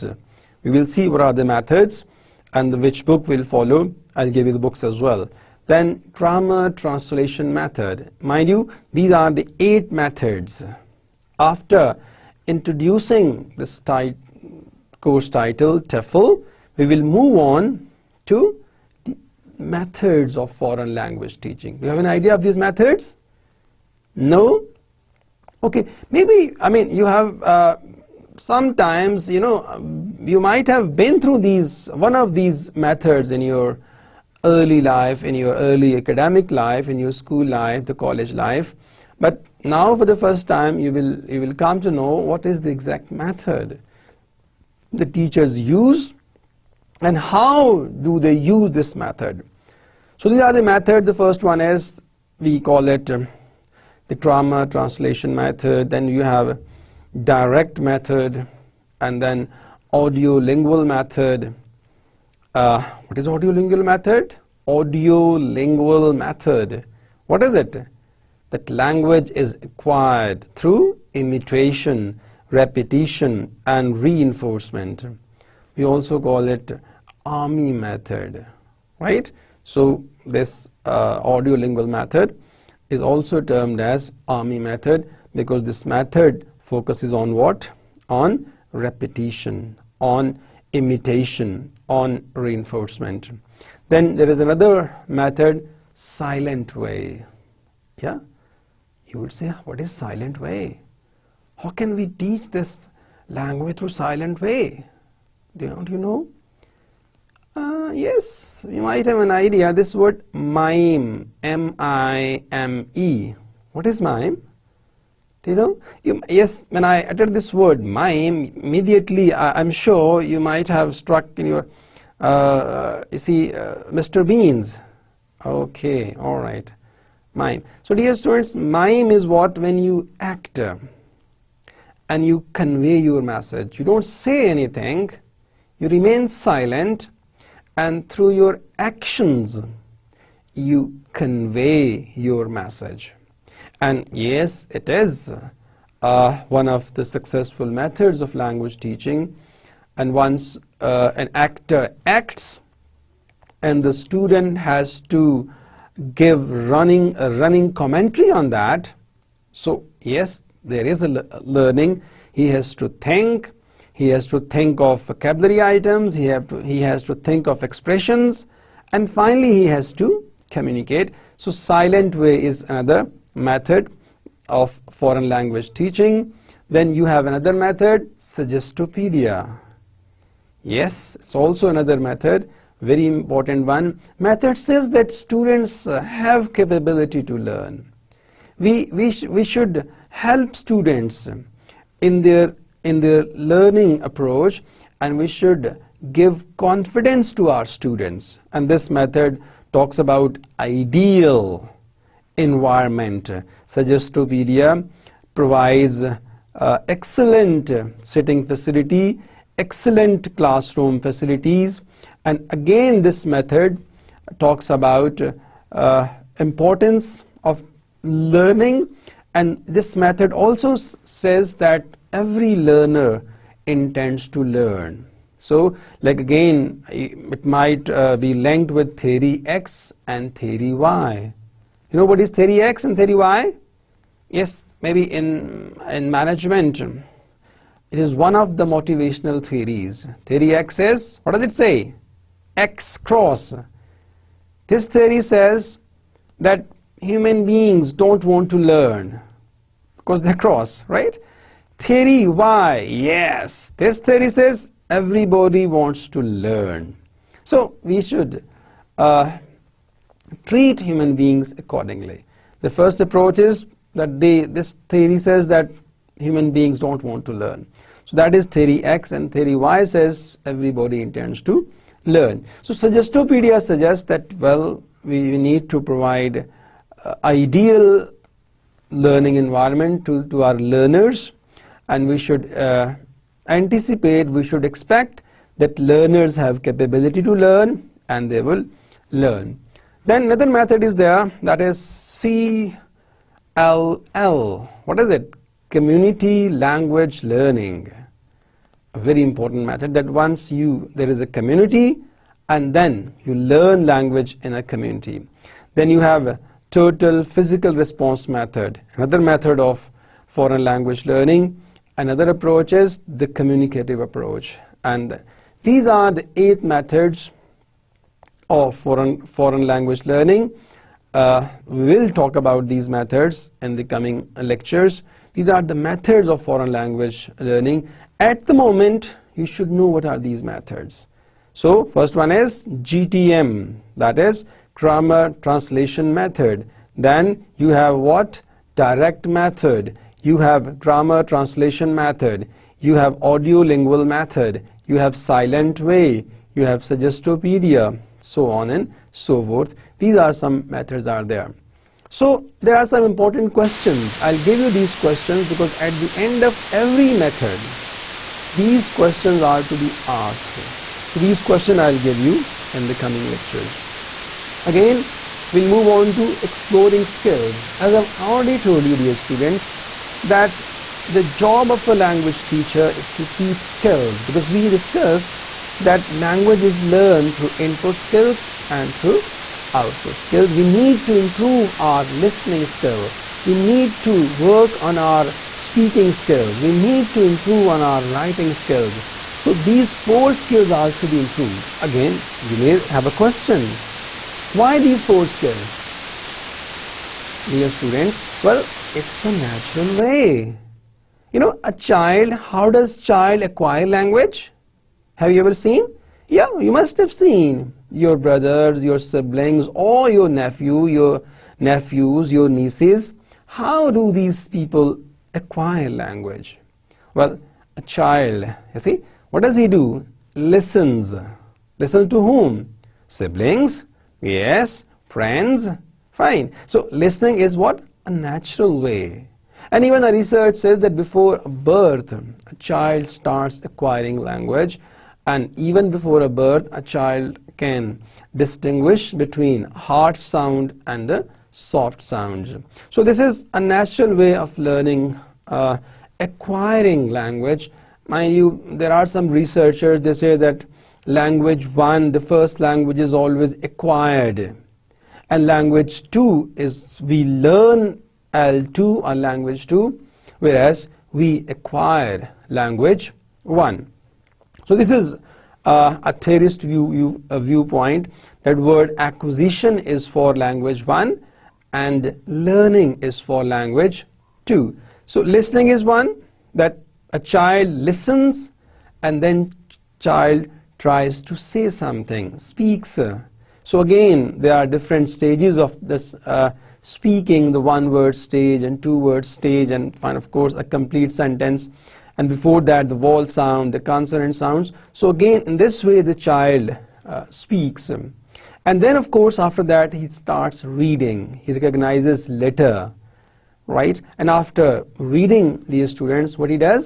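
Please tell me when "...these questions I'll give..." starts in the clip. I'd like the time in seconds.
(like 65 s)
361 s.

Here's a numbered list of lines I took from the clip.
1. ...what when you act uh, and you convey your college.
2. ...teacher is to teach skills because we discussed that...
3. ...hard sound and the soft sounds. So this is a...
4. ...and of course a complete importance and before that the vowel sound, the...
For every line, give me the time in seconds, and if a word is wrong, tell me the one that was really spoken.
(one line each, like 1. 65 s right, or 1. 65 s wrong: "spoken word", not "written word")
1. 129 s wrong: "message", not "college"
2. 372 s right
3. 439 s right
4. 489 s wrong: "sentence", not "importance".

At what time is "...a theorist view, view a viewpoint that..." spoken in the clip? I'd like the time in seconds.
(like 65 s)
466 s.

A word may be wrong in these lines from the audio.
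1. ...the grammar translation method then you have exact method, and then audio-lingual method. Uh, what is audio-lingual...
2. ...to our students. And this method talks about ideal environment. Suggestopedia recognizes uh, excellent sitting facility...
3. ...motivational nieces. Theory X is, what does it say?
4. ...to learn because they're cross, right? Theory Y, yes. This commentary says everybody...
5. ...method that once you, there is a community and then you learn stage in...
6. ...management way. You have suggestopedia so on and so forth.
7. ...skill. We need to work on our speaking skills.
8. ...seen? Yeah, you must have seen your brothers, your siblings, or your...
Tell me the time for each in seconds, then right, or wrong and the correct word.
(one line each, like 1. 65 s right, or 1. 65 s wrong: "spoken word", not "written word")
1. 54 s wrong: "direct", not "exact"
2. 197 s wrong: "provides", not "recognizes"
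3. 238 s wrong: "theories", not "nieces"
4. 248 s wrong: "theory", not "commentary"
5. 299 s wrong: "language", not "stage"
6. 345 s wrong: "silent", not "management"
7. 382 s right
8. 405 s right.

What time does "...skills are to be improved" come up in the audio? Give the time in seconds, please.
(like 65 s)
390 s.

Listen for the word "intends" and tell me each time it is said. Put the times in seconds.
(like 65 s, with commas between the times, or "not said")
223 s, 271 s.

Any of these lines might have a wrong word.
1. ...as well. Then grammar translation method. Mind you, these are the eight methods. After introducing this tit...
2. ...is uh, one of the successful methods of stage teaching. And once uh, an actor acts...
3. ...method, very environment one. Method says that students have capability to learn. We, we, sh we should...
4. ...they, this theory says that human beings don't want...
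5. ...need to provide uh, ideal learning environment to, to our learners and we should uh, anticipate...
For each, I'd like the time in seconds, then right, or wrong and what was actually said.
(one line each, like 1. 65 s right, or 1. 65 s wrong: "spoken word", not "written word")
1. 4 s right
2. 144 s wrong: "language", not "stage"
3. 181 s wrong: "important", not "environment"
4. 264 s right
5. 275 s right.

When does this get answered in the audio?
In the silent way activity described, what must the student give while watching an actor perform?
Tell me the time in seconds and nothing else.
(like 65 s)
157 s.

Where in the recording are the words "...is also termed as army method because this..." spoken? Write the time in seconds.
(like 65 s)
82 s.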